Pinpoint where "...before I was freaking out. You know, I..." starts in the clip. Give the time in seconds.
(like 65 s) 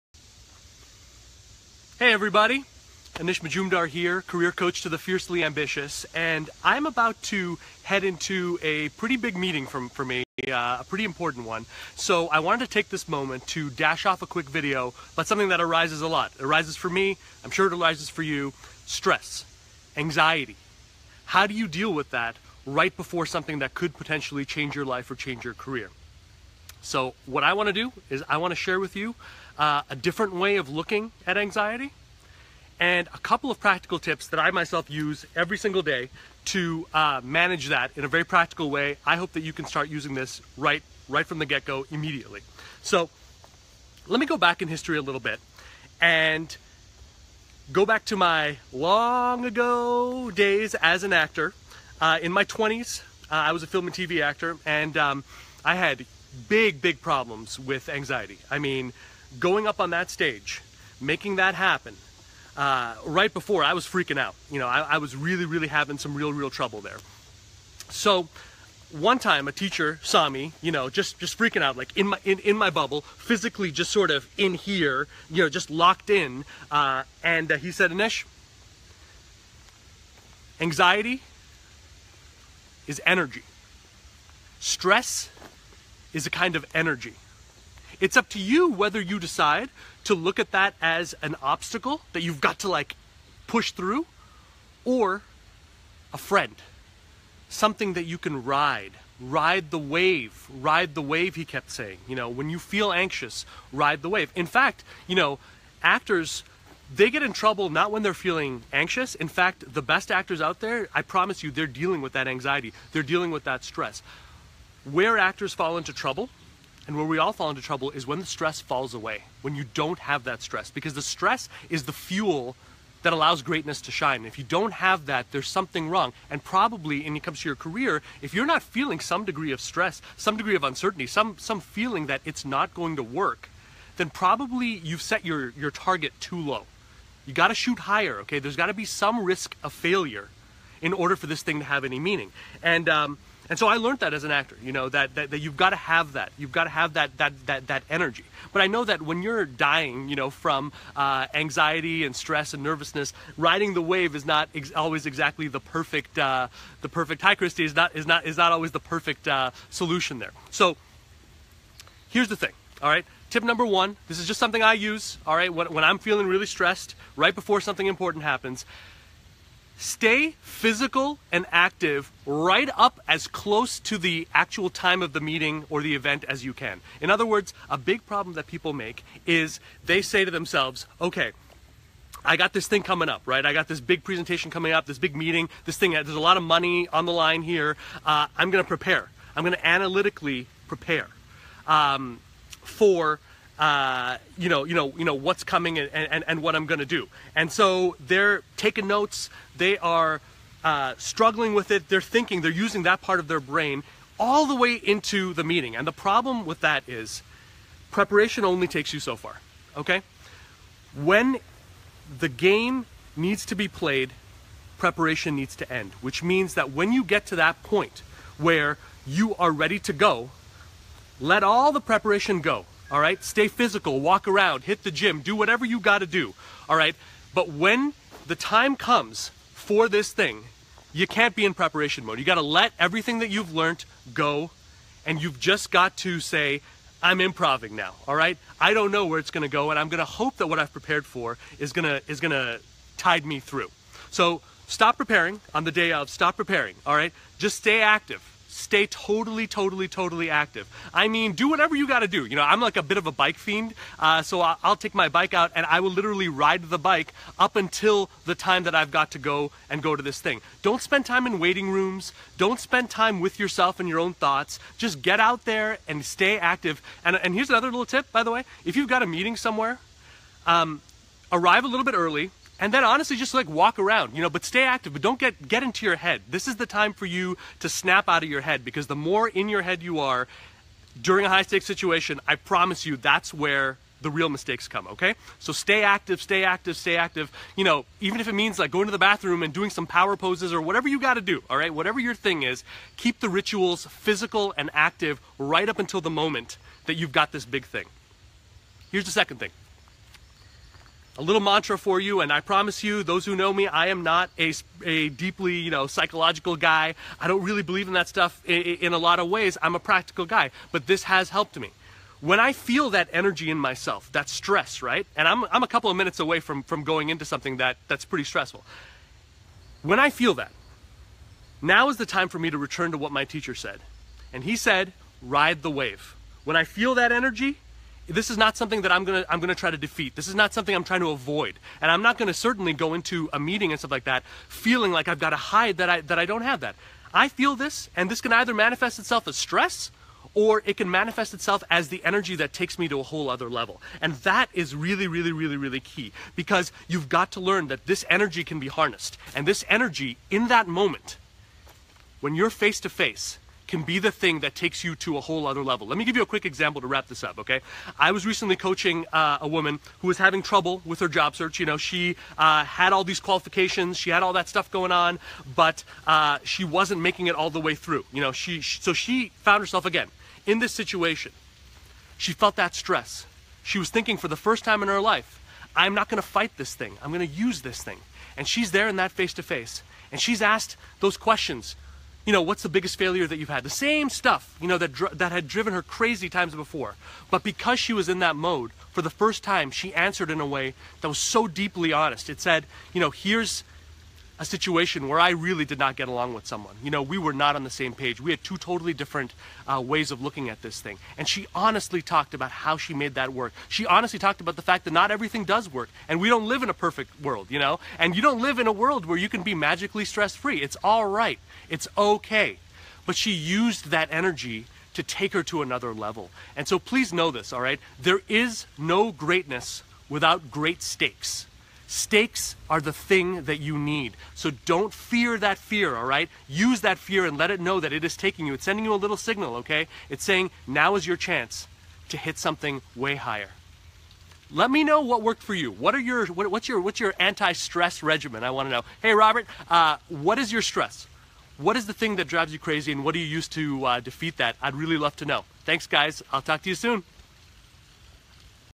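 63 s.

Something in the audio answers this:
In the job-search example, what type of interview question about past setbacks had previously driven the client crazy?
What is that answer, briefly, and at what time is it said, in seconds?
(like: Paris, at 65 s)
biggest failure, at 382 s.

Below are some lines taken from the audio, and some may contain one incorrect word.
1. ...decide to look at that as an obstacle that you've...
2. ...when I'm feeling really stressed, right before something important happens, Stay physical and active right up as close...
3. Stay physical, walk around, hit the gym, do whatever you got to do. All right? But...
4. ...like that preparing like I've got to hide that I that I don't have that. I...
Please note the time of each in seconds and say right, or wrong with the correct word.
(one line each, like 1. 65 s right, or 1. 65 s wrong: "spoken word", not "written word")
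1. 89 s right
2. 165 s right
3. 223 s right
4. 333 s wrong: "feeling", not "preparing".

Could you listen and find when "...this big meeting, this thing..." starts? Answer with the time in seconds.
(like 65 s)
184 s.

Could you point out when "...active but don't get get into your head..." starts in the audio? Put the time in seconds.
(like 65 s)
274 s.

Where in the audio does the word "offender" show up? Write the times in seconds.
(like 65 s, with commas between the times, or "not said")
not said.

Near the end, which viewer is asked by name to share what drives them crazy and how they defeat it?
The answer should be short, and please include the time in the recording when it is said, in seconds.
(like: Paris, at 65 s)
Robert, at 439 s.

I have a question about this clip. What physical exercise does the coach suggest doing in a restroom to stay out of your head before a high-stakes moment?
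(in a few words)
power poses.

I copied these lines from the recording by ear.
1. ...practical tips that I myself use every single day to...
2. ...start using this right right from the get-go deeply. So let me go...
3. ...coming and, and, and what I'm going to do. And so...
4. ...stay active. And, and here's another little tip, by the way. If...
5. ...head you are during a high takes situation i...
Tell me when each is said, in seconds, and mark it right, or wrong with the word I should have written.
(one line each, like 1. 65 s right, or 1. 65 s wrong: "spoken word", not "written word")
1. 33 s right
2. 39 s wrong: "immediately", not "deeply"
3. 195 s right
4. 266 s right
5. 279 s wrong: "stakes", not "takes".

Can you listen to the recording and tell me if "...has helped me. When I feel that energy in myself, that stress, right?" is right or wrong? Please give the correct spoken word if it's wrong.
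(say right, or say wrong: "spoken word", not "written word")
right.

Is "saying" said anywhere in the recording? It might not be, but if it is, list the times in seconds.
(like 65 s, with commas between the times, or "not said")
101 s, 430 s.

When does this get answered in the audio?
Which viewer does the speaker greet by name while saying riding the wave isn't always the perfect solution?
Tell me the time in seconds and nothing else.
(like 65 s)
157 s.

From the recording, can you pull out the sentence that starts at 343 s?
And that is really, really, really, really key because you've got to learn that this energy can be harnessed.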